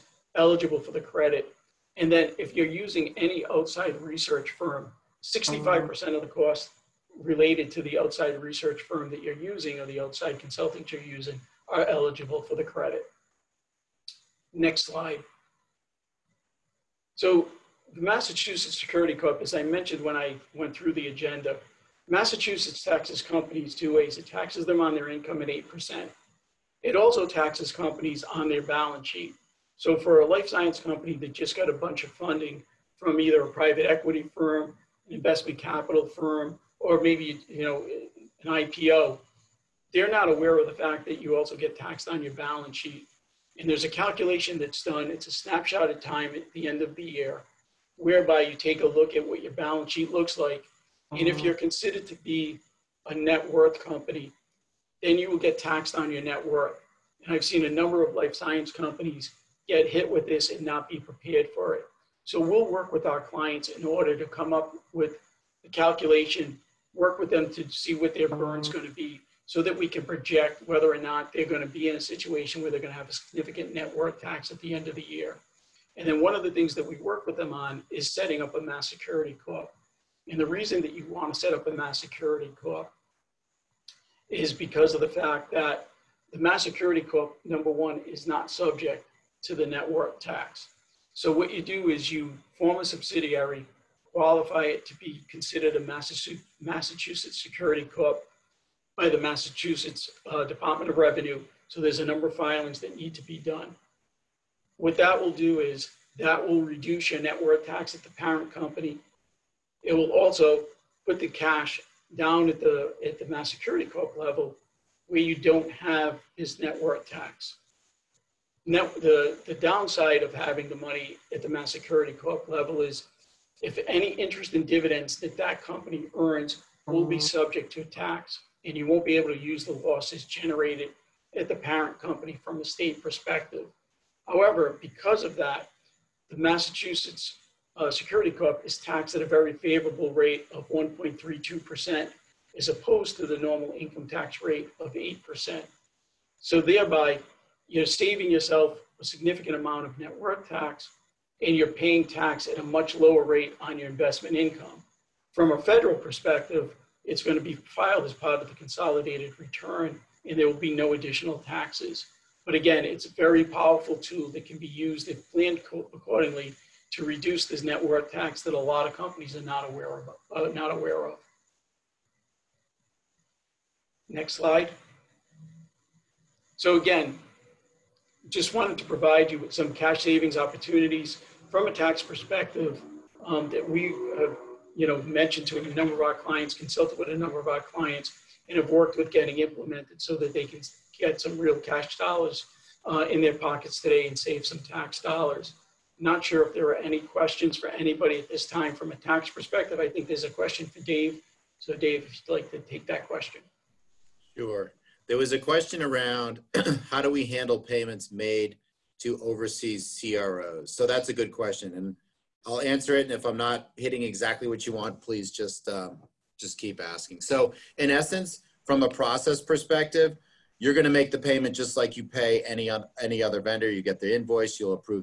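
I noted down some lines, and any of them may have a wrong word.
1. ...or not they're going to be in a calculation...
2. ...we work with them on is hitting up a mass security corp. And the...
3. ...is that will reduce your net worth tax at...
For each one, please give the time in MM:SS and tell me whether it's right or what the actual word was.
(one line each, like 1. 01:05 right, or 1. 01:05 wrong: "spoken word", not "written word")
1. 01:10 wrong: "situation", not "calculation"
2. 01:16 wrong: "setting", not "hitting"
3. 01:45 right.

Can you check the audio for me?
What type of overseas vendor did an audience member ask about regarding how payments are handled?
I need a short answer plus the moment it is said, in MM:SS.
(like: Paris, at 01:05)
CROs, at 03:30.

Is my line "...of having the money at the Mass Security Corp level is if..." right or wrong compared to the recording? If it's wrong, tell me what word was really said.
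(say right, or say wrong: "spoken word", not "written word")
right.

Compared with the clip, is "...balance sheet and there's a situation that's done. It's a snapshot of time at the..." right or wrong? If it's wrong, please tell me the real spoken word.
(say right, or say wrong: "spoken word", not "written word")
wrong: "calculation", not "situation".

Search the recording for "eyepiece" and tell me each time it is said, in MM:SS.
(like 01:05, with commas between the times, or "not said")
not said.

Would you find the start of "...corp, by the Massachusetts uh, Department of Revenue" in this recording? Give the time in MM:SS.
01:37.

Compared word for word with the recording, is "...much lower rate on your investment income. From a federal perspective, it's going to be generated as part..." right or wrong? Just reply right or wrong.
wrong.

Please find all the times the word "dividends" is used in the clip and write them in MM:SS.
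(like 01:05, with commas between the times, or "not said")
02:04.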